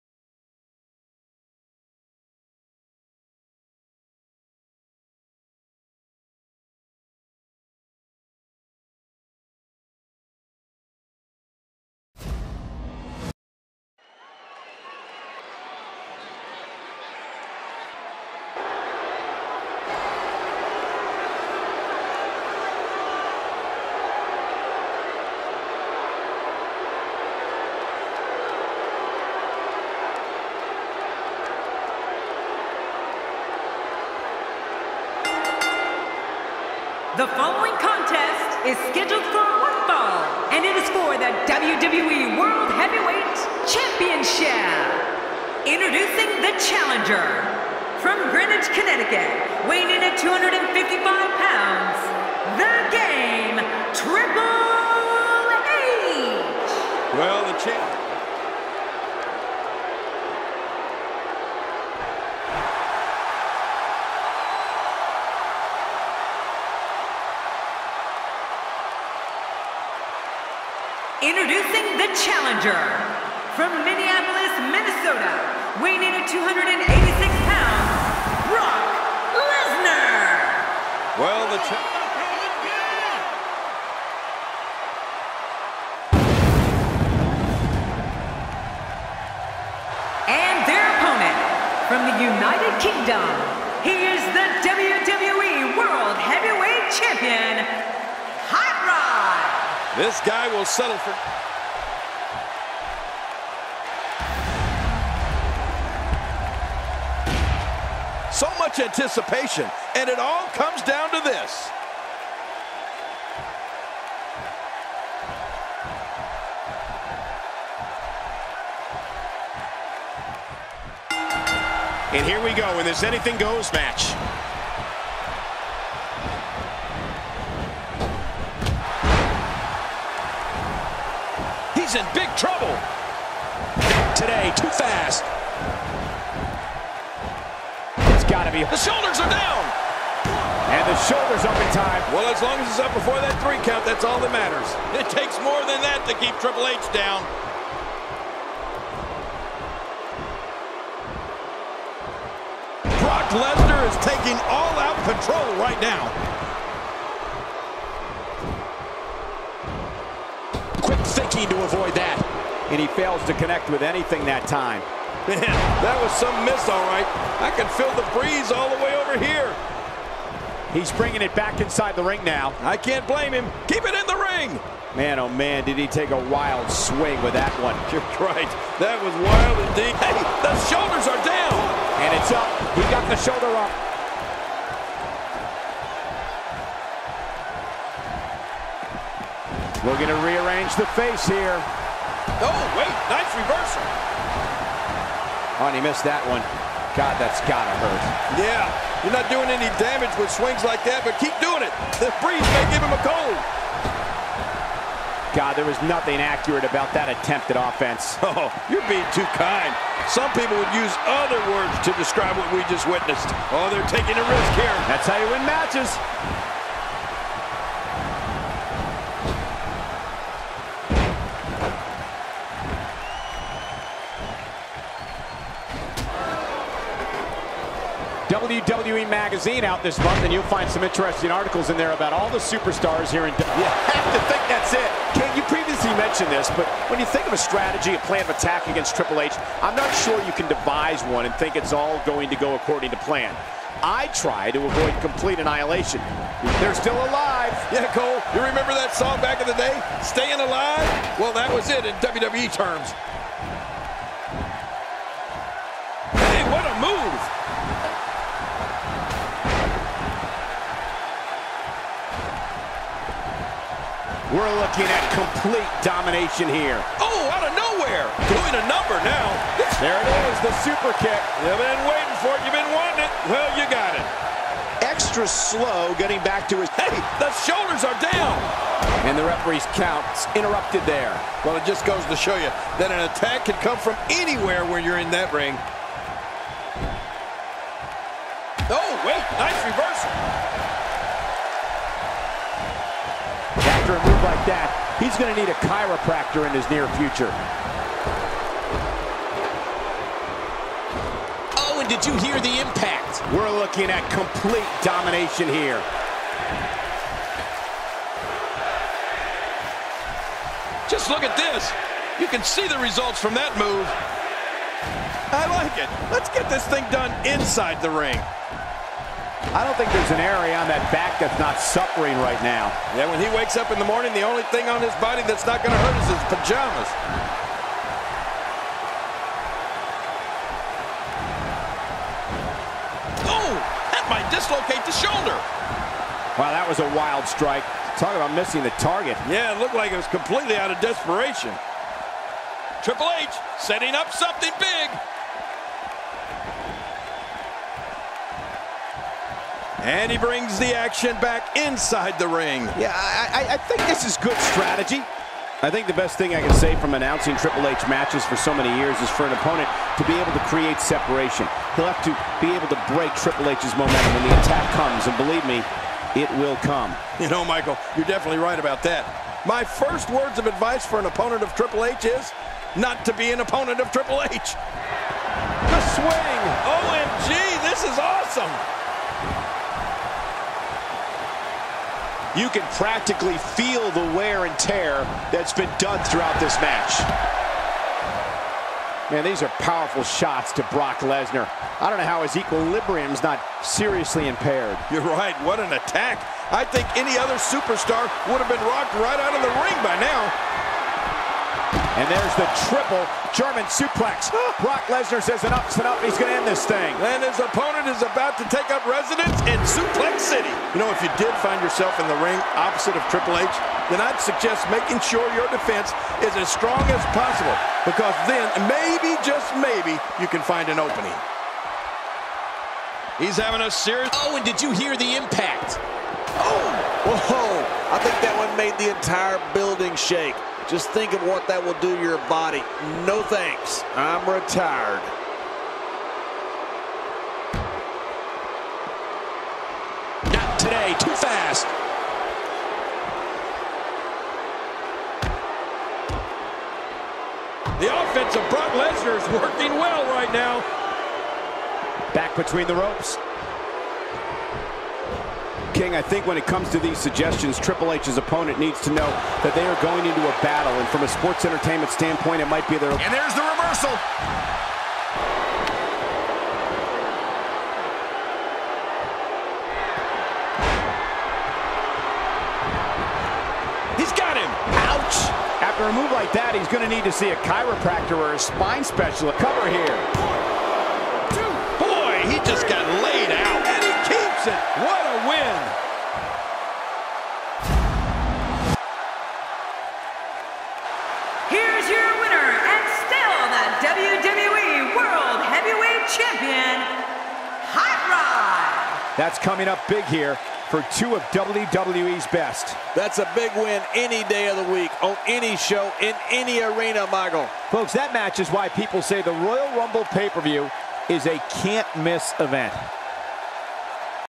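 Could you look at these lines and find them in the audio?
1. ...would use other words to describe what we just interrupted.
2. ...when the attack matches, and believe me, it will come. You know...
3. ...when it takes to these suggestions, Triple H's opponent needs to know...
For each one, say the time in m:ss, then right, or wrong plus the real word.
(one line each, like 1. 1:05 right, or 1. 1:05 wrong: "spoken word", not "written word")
1. 3:30 wrong: "witnessed", not "interrupted"
2. 6:04 wrong: "comes", not "matches"
3. 7:36 wrong: "comes", not "takes".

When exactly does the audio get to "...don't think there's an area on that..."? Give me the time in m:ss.
5:19.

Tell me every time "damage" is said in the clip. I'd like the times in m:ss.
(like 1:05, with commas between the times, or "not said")
3:19.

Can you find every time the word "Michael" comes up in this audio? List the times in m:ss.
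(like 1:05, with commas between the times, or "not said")
6:07, 8:27.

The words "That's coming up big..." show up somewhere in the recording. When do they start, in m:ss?
8:19.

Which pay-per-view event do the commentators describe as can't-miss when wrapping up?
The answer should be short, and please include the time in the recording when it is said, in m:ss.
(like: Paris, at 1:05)
Royal Rumble, at 8:29.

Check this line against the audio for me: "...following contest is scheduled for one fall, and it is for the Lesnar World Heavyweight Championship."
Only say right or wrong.
wrong.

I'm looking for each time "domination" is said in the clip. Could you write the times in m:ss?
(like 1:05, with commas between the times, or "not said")
4:25, 5:04.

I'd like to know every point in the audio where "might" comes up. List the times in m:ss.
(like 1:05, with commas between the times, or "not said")
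5:34, 7:42.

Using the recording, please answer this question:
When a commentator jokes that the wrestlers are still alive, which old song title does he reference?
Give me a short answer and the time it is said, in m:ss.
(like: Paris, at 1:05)
Staying Alive, at 4:10.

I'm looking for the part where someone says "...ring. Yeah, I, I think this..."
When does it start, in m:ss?
5:52.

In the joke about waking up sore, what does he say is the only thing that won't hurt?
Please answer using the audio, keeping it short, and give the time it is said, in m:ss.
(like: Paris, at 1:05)
his pajamas, at 5:26.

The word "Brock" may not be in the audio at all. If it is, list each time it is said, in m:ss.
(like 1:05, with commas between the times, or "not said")
1:18, 2:33, 6:30, 6:44, 7:28.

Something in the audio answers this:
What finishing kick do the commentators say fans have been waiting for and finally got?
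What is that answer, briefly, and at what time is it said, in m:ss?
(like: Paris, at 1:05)
super kick, at 4:30.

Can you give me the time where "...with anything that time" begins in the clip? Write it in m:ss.
2:43.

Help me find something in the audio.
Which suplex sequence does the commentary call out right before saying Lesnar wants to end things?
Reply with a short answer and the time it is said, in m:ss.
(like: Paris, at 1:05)
triple German suplex, at 6:42.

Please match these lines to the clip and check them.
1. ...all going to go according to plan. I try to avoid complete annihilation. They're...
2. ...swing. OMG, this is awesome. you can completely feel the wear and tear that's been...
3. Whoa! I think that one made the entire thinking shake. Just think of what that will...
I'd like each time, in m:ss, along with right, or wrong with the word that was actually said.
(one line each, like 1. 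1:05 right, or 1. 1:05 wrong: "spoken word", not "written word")
1. 4:01 right
2. 6:15 wrong: "practically", not "completely"
3. 7:07 wrong: "building", not "thinking".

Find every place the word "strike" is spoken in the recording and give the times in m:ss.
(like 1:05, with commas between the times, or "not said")
5:37.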